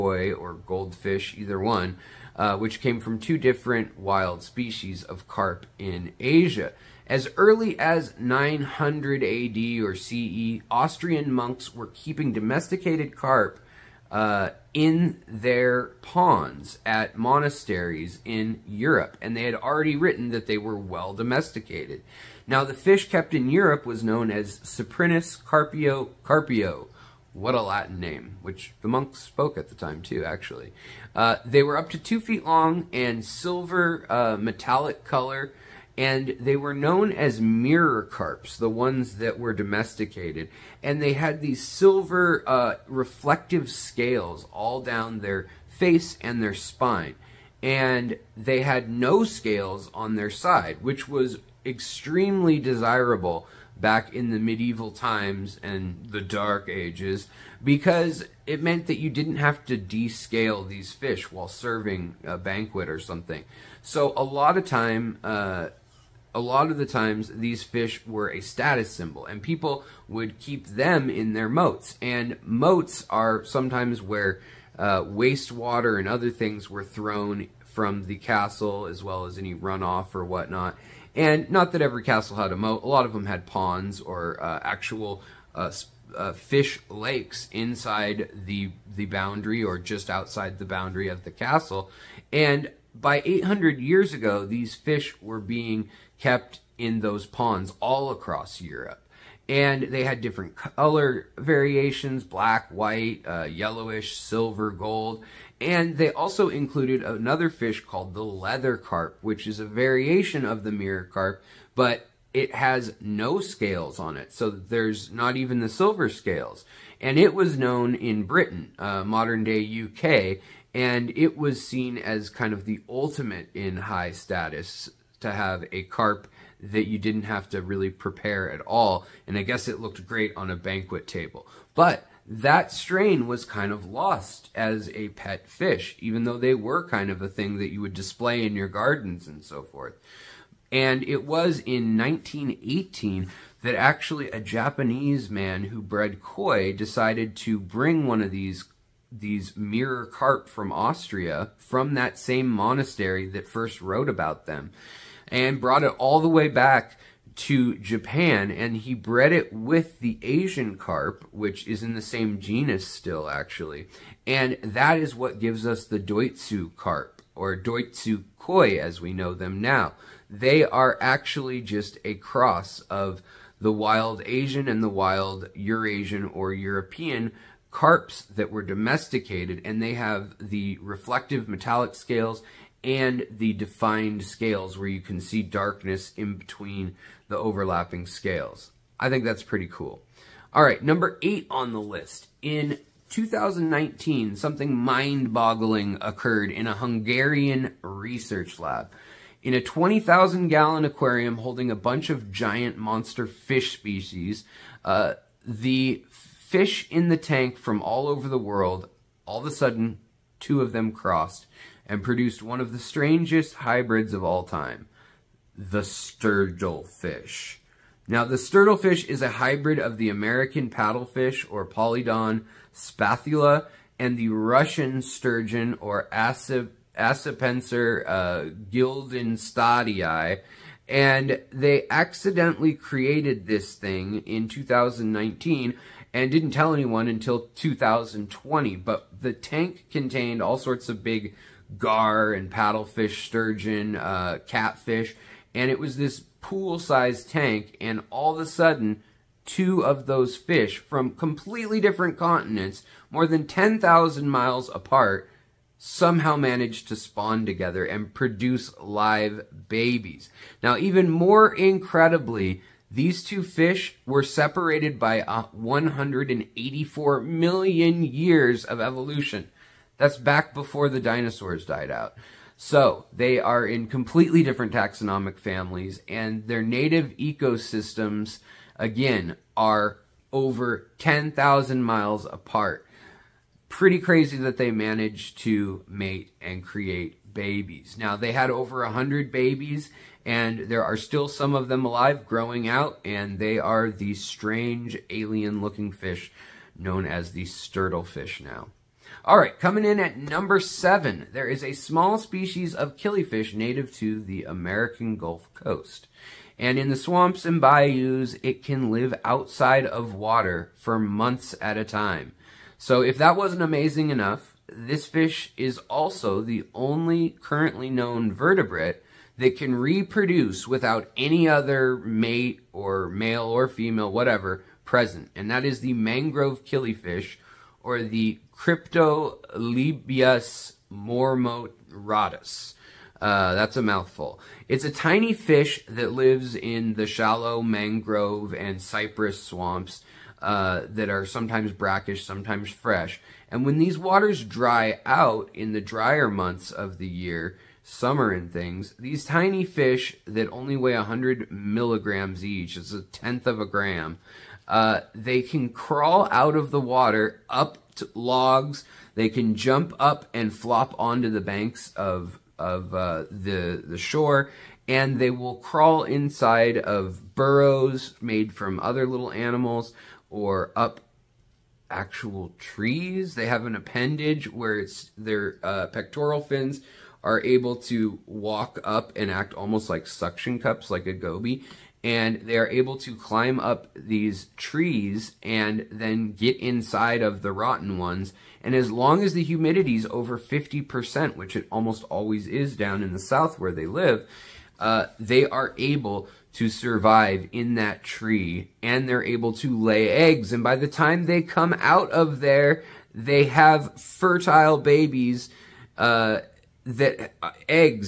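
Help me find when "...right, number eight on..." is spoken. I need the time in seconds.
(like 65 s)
190 s.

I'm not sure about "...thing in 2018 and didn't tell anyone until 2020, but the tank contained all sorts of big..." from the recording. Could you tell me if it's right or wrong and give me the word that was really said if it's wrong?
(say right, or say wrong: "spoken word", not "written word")
wrong: "2019", not "2018".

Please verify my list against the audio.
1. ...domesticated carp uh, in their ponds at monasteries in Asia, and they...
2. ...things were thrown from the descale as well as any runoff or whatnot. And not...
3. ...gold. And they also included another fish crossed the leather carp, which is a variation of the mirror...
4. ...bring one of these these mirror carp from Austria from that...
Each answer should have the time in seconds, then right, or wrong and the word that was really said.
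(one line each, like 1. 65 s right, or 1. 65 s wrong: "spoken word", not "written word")
1. 12 s wrong: "Europe", not "Asia"
2. 76 s wrong: "castle", not "descale"
3. 104 s wrong: "called", not "crossed"
4. 147 s right.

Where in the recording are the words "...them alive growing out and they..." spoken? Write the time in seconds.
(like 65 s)
291 s.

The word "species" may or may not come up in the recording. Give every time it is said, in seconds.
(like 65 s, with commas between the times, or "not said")
4 s, 203 s, 302 s.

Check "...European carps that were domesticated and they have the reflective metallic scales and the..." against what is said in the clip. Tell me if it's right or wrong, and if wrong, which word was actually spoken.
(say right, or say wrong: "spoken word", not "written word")
right.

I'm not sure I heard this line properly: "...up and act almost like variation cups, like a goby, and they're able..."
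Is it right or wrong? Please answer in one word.
wrong.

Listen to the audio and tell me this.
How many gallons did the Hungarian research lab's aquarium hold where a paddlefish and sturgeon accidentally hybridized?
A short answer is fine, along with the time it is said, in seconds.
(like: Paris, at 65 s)
20,000 gallons, at 199 s.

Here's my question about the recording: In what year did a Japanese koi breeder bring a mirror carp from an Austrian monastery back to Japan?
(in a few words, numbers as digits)
1918.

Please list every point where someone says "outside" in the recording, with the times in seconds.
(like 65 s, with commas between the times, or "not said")
90 s, 309 s.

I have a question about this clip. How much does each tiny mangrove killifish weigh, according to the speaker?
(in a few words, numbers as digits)
100 milligrams.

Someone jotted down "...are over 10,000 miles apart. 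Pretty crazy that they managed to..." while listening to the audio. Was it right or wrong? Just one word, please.
right.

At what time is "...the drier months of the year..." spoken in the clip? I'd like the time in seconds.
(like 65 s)
345 s.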